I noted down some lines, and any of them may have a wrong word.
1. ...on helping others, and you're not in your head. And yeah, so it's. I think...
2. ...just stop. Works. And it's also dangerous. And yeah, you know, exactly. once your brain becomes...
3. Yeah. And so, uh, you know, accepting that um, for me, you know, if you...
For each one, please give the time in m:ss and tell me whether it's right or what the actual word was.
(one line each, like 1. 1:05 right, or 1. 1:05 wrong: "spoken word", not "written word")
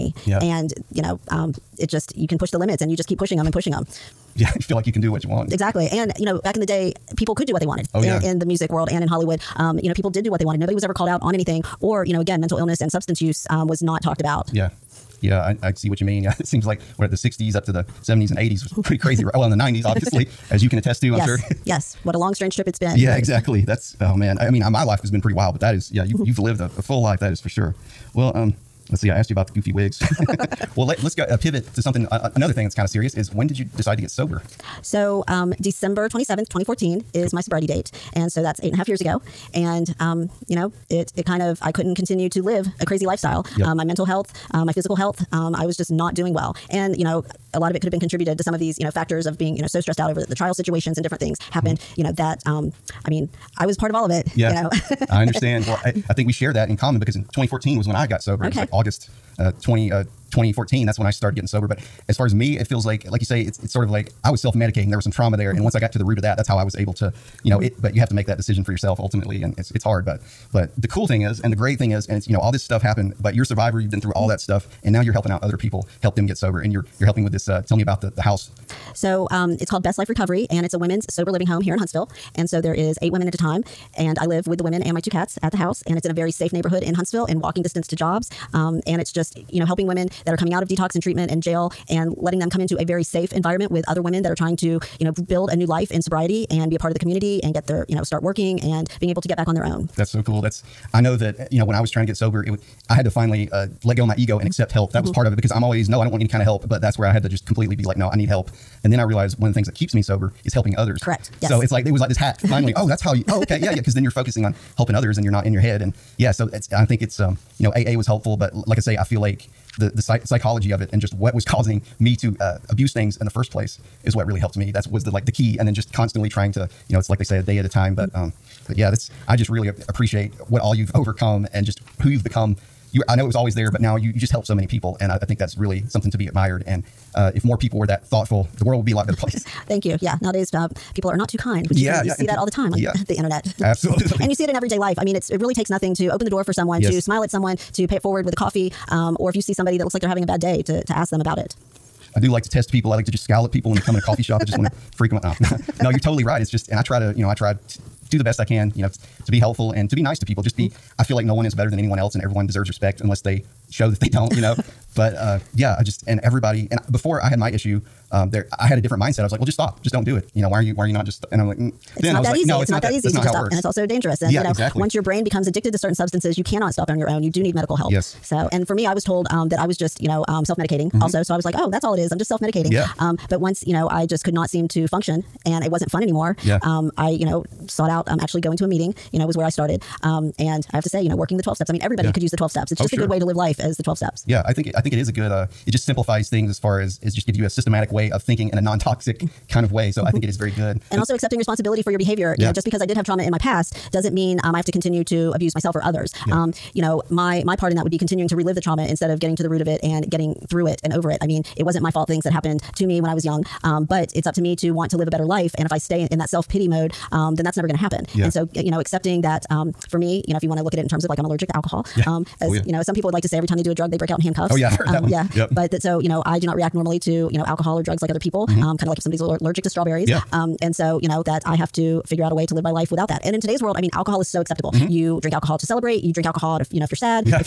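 1. 1:54 right
2. 2:53 right
3. 3:38 right.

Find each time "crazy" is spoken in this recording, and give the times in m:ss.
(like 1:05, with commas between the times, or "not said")
0:18, 0:42.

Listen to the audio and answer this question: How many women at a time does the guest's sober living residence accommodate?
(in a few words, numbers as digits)
8.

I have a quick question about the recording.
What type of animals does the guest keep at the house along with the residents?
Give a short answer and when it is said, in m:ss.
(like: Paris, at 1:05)
cats, at 1:24.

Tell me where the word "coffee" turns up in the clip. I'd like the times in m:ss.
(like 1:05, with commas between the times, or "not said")
2:28, 2:33.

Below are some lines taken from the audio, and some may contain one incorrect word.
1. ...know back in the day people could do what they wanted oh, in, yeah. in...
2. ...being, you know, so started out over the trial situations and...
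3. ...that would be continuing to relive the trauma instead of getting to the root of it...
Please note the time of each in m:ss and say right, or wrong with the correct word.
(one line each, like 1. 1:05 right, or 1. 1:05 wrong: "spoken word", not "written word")
1. 0:06 right
2. 0:49 wrong: "stressed", not "started"
3. 3:27 right.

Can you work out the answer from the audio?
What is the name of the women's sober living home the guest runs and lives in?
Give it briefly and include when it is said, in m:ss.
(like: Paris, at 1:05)
Best Life Recovery, at 1:19.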